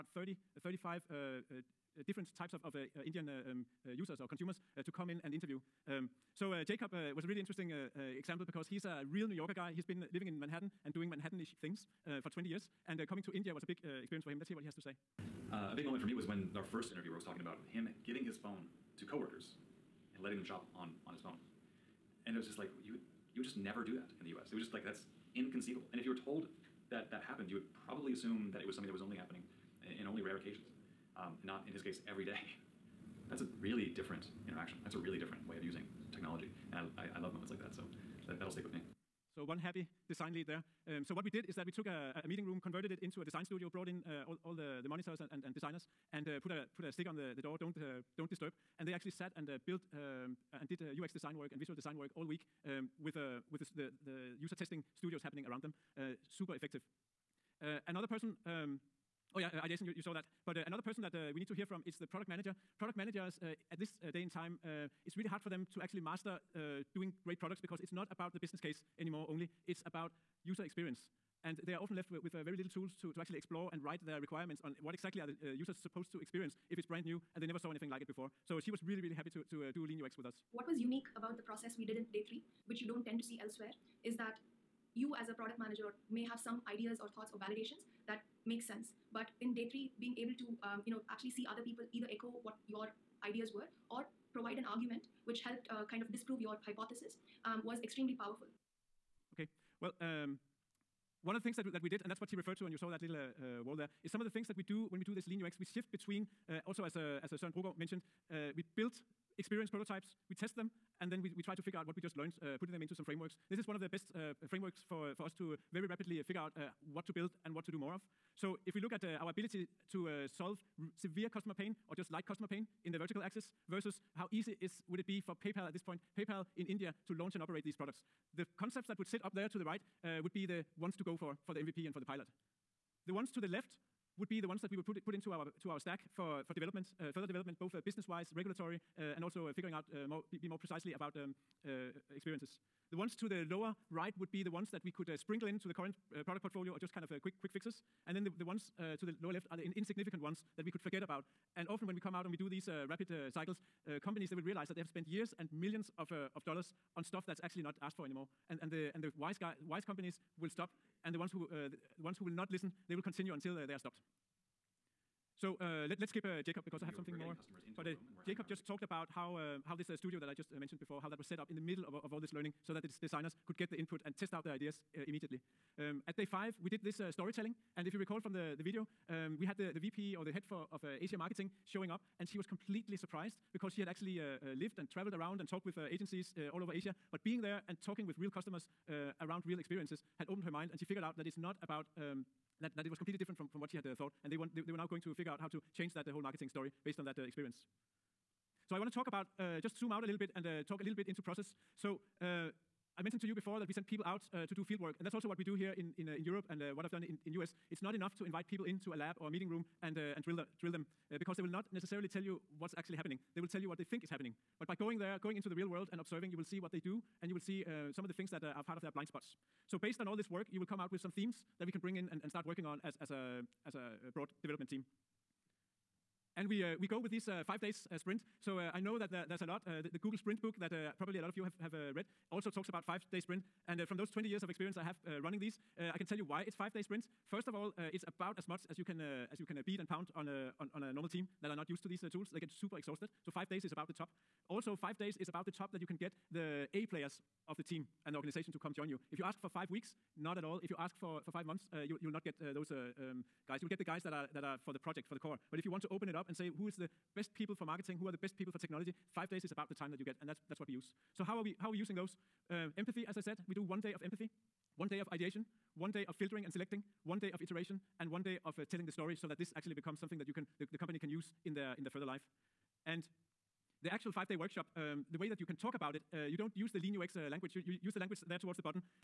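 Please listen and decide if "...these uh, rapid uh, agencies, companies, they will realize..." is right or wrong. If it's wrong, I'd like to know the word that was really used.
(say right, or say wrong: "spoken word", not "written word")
wrong: "cycles", not "agencies".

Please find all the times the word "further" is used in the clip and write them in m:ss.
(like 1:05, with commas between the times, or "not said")
2:17, 4:31.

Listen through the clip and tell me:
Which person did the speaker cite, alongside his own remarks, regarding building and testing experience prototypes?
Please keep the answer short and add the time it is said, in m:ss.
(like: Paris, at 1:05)
Søren Brogaard, at 1:47.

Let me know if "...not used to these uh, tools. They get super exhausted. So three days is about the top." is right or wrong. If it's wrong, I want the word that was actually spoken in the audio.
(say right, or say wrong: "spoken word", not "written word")
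wrong: "five", not "three".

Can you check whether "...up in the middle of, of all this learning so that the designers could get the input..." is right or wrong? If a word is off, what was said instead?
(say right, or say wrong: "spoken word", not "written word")
right.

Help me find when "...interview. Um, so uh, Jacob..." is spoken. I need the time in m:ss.
0:05.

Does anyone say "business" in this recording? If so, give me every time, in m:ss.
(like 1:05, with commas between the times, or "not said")
1:08, 2:17.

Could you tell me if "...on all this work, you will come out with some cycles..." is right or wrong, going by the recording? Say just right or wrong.
wrong.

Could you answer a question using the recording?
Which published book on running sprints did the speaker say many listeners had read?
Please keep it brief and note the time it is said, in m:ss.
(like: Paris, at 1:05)
Google Sprint book, at 3:49.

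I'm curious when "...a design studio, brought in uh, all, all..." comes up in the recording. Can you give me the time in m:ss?
0:43.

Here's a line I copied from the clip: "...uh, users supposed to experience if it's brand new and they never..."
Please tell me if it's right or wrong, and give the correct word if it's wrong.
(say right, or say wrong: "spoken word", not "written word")
right.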